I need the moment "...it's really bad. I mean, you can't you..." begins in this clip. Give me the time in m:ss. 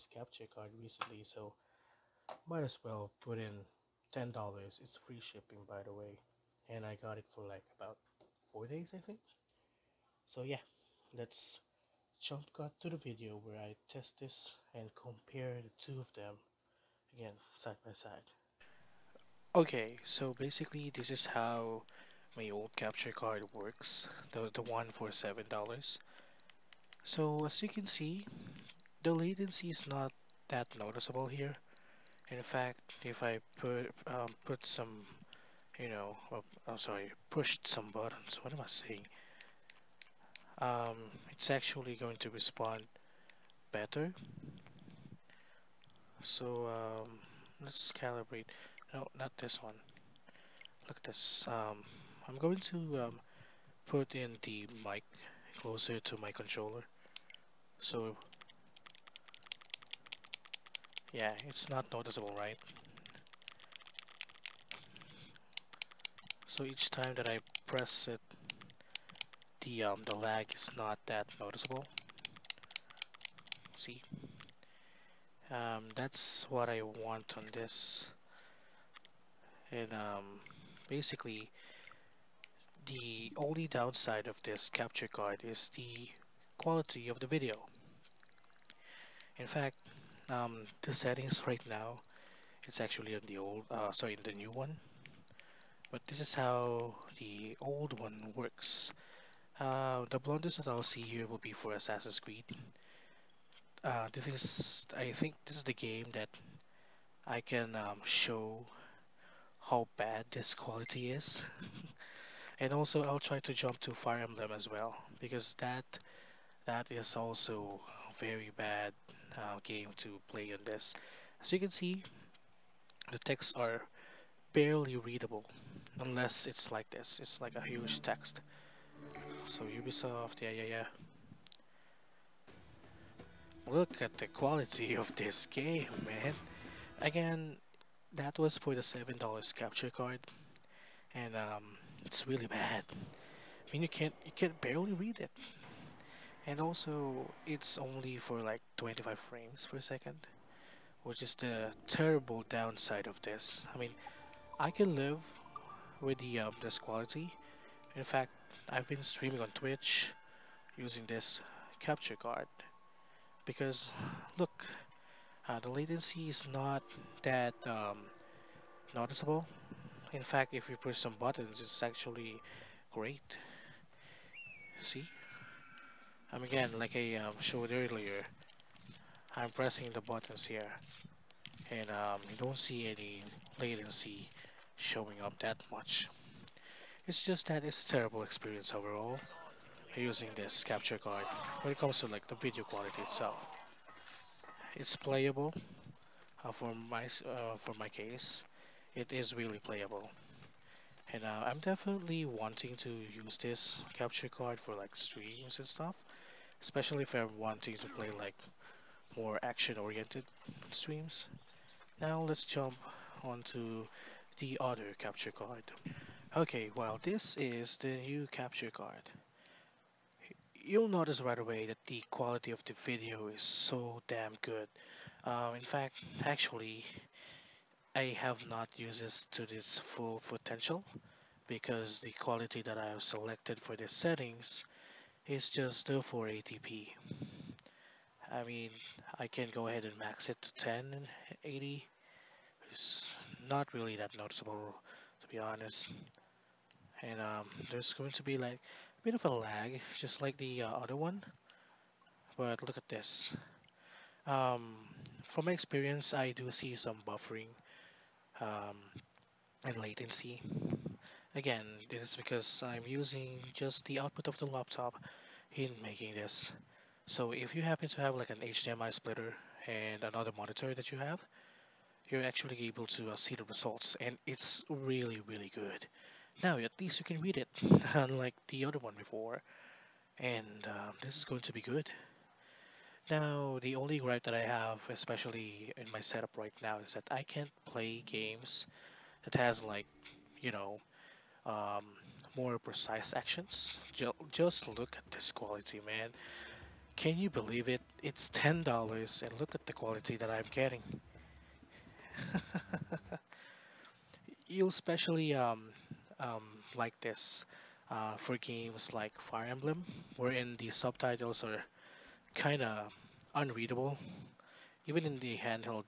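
2:22.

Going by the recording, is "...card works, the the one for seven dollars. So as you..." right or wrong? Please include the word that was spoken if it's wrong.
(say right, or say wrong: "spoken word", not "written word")
right.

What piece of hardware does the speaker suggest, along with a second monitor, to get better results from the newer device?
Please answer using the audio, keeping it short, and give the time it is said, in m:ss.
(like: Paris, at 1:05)
HDMI splitter, at 4:28.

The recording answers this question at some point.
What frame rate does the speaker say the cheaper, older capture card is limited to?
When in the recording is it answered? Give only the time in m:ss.
2:28.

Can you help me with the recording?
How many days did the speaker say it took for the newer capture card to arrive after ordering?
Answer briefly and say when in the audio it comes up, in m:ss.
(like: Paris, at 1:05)
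4, at 0:08.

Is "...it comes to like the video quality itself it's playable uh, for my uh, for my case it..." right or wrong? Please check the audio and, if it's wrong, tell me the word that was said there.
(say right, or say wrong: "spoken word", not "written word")
right.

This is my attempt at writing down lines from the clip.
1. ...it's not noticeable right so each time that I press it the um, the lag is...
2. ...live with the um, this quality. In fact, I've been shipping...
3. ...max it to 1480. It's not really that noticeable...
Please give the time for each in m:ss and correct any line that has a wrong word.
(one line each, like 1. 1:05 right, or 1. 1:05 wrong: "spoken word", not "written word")
1. 1:01 right
2. 2:34 wrong: "streaming", not "shipping"
3. 3:59 wrong: "1080", not "1480".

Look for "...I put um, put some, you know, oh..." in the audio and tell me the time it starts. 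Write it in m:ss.
0:33.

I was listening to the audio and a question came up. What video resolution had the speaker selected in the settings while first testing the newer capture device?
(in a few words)
480p.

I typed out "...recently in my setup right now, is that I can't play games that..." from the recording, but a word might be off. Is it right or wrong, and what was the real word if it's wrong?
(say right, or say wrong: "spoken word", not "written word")
wrong: "especially", not "recently".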